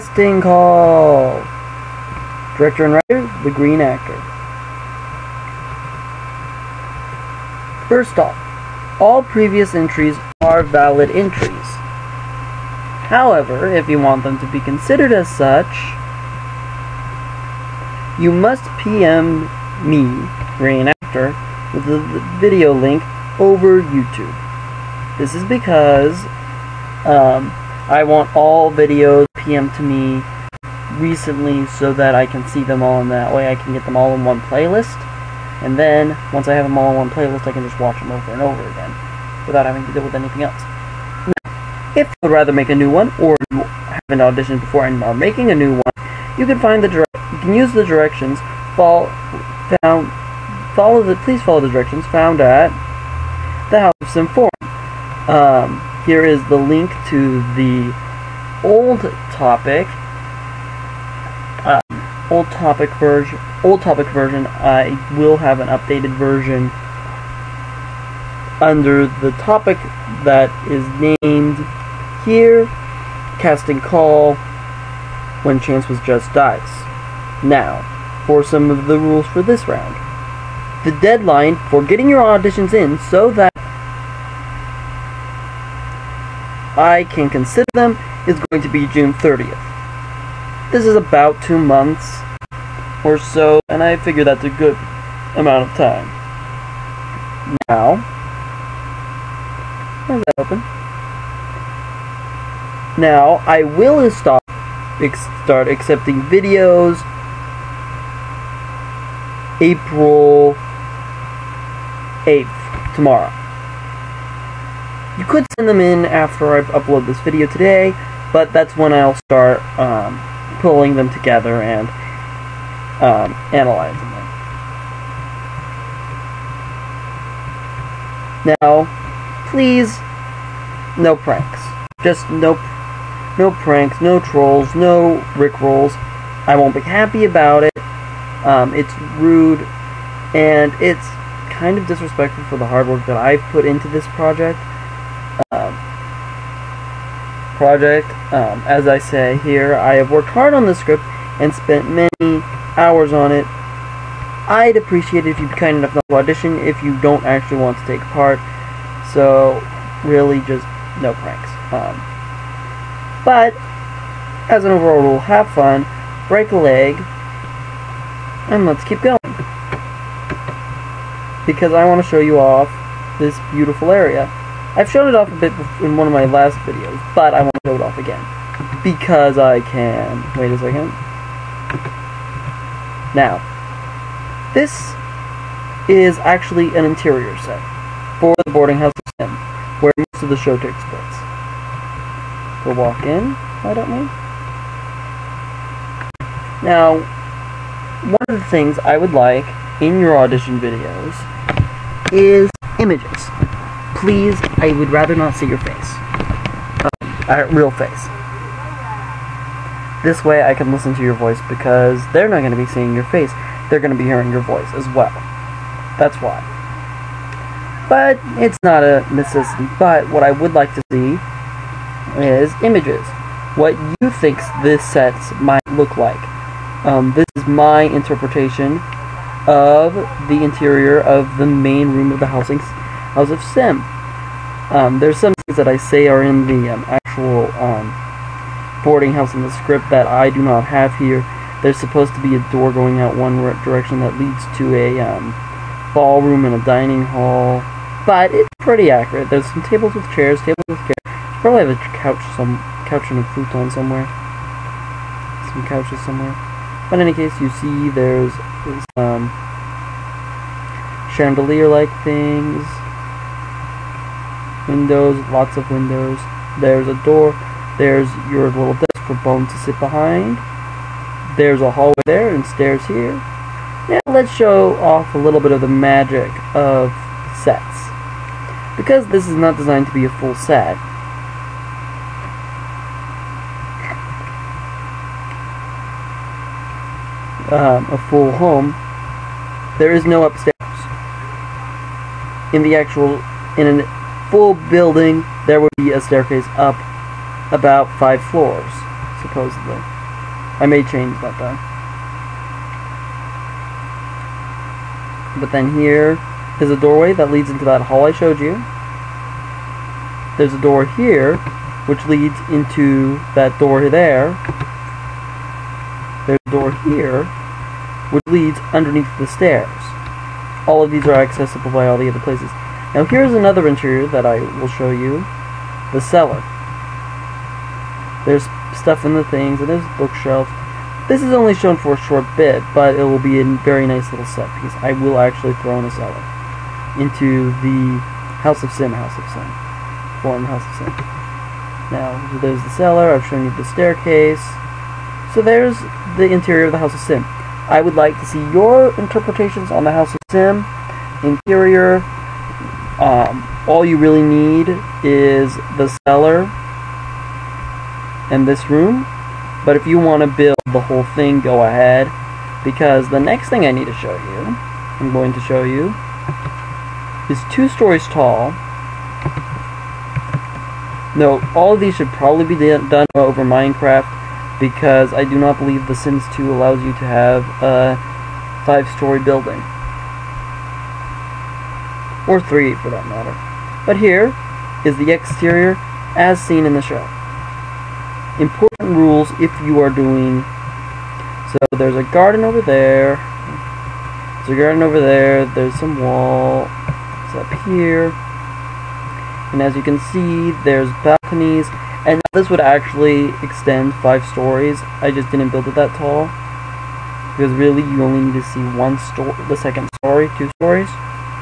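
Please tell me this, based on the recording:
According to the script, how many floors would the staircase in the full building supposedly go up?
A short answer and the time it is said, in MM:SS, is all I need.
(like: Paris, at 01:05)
5, at 04:57.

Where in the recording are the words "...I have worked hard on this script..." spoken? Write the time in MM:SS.
02:29.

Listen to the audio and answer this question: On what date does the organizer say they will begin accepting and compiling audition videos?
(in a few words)
April 8th.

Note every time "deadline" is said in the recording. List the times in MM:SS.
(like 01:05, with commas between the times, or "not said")
01:20.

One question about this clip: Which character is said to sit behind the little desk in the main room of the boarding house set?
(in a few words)
Bone.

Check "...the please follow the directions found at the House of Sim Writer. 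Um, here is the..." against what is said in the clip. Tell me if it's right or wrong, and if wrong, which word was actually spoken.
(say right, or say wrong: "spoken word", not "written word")
wrong: "Forum", not "Writer".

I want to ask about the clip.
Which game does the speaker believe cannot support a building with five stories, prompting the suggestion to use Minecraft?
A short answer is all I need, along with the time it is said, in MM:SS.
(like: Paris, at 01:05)
The Sims 2, at 06:15.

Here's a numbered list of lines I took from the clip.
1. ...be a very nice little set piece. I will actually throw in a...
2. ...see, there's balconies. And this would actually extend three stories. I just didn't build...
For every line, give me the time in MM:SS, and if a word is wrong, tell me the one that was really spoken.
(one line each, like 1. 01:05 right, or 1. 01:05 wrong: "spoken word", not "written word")
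1. 05:33 right
2. 06:40 wrong: "five", not "three".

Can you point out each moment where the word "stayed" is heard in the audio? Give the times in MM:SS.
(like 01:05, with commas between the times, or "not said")
not said.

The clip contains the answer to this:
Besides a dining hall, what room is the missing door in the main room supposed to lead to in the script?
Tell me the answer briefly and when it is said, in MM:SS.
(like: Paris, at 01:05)
ballroom, at 04:05.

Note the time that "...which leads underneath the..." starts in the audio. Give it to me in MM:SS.
05:18.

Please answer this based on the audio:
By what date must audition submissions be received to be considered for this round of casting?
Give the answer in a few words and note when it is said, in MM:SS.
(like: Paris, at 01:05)
June 30th, at 01:28.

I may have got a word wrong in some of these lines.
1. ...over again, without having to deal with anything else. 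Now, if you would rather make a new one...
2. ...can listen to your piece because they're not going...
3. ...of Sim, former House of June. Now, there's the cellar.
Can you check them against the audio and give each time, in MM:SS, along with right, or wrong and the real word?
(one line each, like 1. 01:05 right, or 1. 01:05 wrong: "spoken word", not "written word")
1. 00:38 right
2. 03:30 wrong: "voice", not "piece"
3. 05:39 wrong: "Sim", not "June".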